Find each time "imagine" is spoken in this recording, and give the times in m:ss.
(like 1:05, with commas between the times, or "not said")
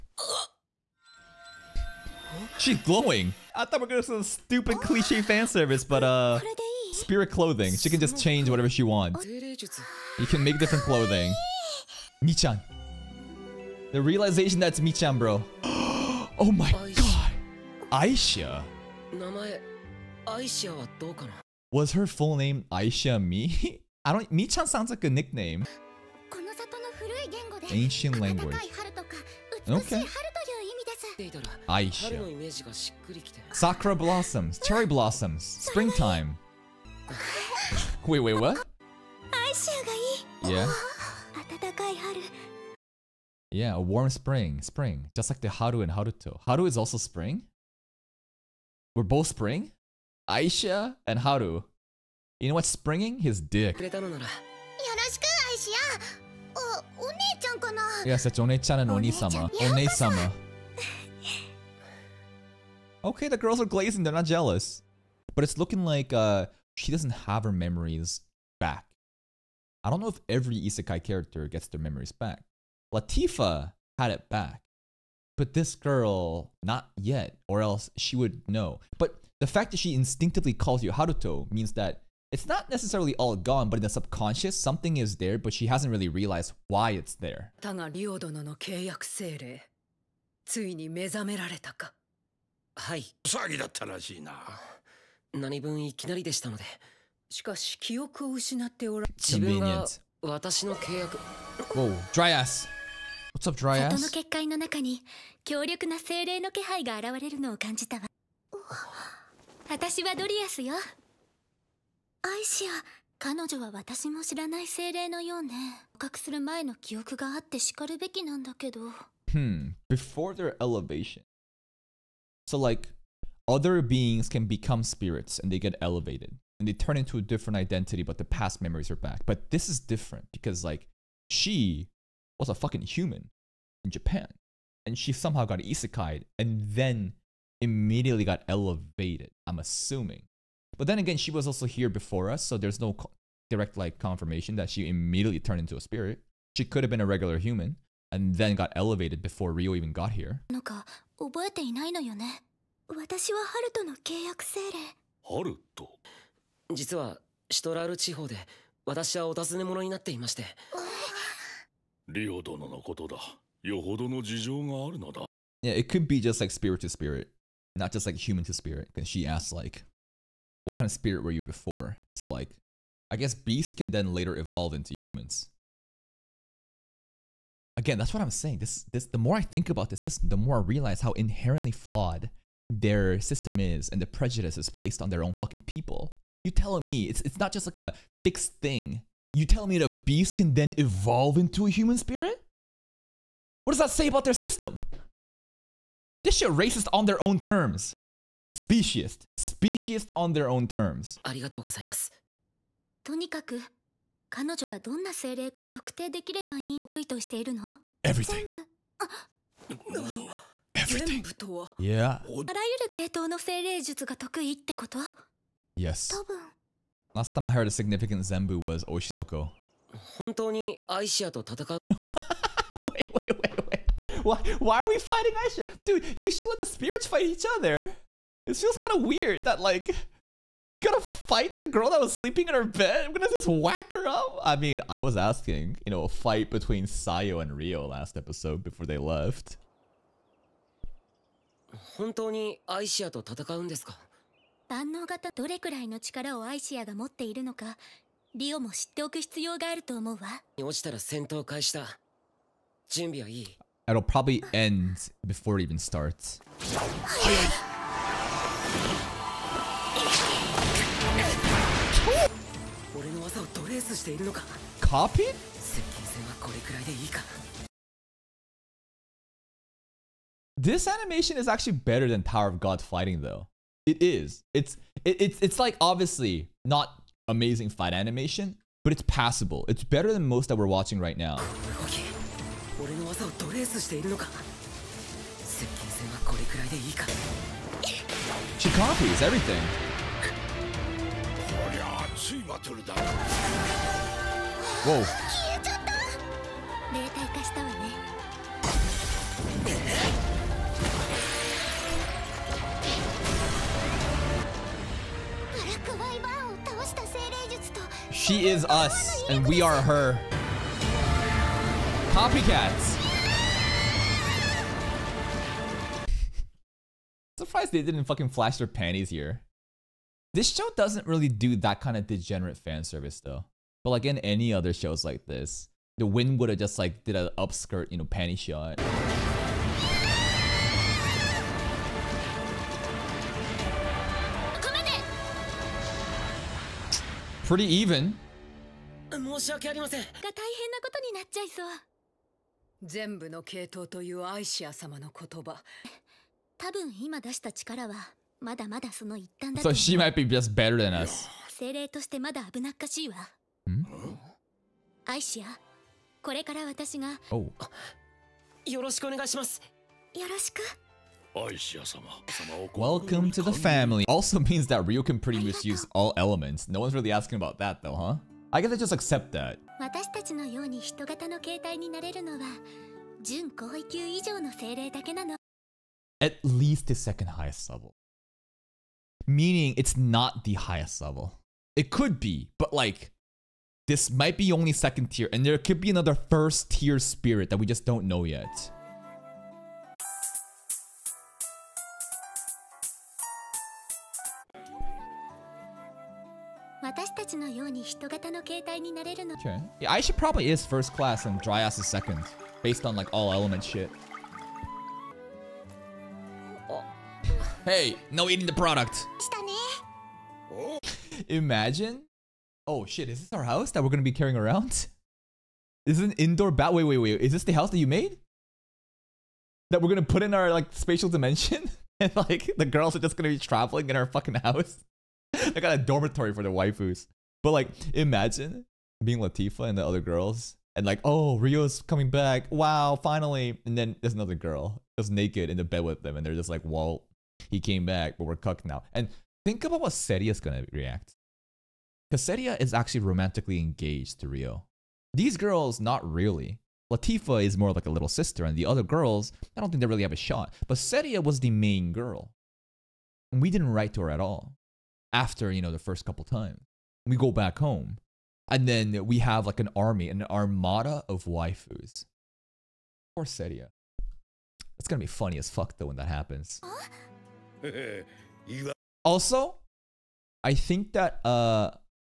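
6:51, 7:07.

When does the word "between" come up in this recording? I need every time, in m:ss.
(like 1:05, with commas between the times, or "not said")
3:56.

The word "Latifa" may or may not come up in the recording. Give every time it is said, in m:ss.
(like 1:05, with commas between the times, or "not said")
1:12, 7:09, 7:26.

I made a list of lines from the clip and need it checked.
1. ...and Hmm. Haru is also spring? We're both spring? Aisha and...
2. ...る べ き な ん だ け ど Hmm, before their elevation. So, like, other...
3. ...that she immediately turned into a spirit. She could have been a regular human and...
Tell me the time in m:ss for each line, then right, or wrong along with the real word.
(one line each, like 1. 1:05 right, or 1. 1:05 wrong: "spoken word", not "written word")
1. 0:45 wrong: "Haruto", not "Hmm"
2. 1:57 right
3. 2:24 right.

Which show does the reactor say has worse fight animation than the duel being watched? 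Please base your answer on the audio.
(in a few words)
Power of God.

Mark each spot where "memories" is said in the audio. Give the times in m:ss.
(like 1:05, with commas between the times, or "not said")
1:07, 1:11, 2:08.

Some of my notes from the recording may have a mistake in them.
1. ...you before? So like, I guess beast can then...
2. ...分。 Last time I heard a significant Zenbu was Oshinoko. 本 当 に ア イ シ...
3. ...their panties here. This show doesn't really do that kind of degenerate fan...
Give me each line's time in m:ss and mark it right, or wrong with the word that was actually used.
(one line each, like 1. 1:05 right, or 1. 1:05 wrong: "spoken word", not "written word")
1. 2:51 right
2. 3:36 right
3. 5:18 right.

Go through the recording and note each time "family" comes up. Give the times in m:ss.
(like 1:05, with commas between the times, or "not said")
6:03.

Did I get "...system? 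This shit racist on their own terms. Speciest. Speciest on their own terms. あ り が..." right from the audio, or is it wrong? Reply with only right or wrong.
right.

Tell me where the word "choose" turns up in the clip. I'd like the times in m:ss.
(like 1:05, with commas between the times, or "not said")
not said.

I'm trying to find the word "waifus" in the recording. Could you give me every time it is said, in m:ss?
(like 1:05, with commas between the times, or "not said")
7:06, 7:41.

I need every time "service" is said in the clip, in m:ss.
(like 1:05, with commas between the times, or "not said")
0:05, 5:22.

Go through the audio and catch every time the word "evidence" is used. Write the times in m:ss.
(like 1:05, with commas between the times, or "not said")
not said.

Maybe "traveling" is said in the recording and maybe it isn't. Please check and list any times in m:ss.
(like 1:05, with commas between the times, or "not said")
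7:03.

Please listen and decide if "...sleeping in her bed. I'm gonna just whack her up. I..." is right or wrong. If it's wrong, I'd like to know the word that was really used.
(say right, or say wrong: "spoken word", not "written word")
right.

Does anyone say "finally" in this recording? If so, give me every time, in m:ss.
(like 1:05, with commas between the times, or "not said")
7:13.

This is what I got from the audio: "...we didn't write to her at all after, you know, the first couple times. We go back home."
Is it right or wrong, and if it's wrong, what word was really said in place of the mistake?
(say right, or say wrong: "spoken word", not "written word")
right.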